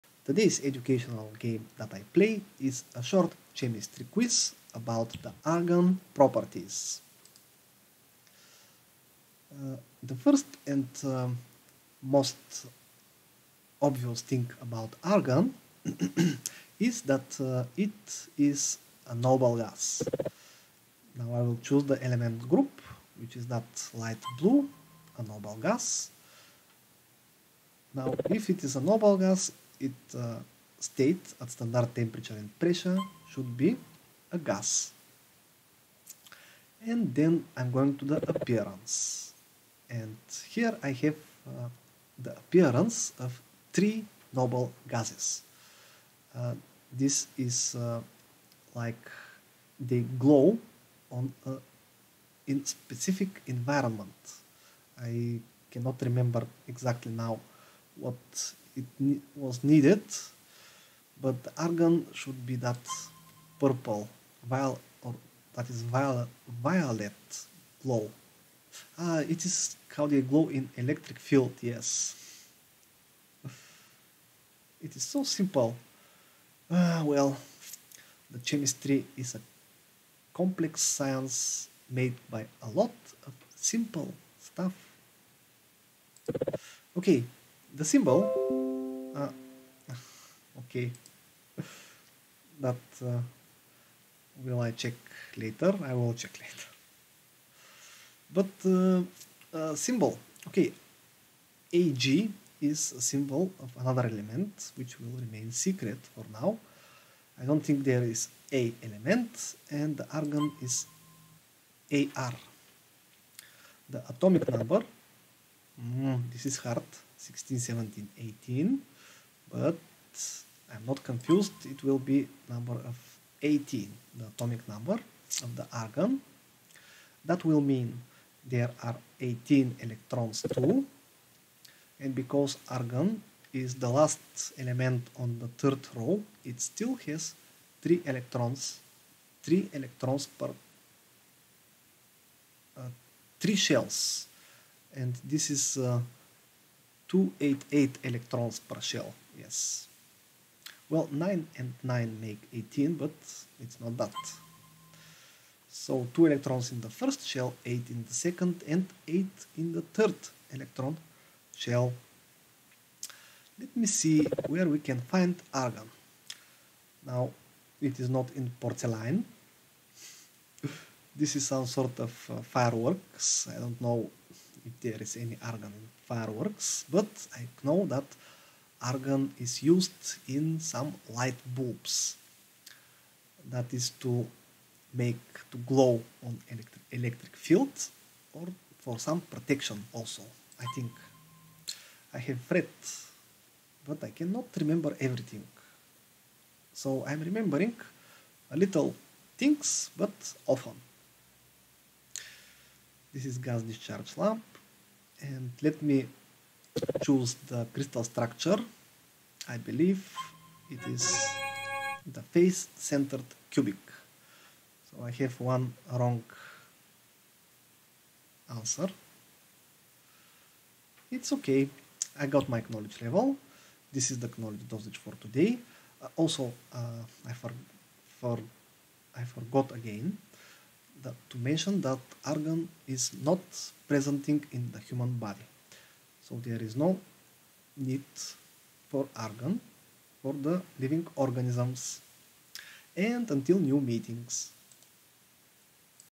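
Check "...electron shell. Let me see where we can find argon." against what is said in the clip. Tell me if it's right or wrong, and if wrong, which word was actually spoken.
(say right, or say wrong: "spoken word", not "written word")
right.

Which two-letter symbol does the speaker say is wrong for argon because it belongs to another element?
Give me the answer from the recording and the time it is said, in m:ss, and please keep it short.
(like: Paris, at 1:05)
AG, at 1:41.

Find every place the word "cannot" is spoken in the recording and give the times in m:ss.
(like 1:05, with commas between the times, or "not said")
0:55, 3:14.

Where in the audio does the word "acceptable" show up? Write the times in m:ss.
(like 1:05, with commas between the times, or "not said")
not said.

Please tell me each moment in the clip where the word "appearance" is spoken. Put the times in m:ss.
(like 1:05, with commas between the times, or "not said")
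0:38, 0:42.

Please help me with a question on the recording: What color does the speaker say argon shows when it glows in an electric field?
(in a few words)
Purple violet.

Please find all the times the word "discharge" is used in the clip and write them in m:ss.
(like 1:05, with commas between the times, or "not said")
3:23.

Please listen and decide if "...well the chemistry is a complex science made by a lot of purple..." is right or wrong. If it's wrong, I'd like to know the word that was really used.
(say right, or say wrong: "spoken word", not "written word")
wrong: "simple", not "purple".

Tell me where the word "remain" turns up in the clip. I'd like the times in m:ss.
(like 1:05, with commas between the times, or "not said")
1:45.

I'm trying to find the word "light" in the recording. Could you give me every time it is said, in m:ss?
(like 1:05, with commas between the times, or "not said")
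0:23, 3:01.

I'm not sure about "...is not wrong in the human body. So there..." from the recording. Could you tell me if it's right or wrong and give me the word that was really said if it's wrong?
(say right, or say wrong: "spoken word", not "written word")
wrong: "presenting", not "wrong".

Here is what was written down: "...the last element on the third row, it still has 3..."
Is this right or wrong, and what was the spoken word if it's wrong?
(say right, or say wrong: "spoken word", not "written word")
right.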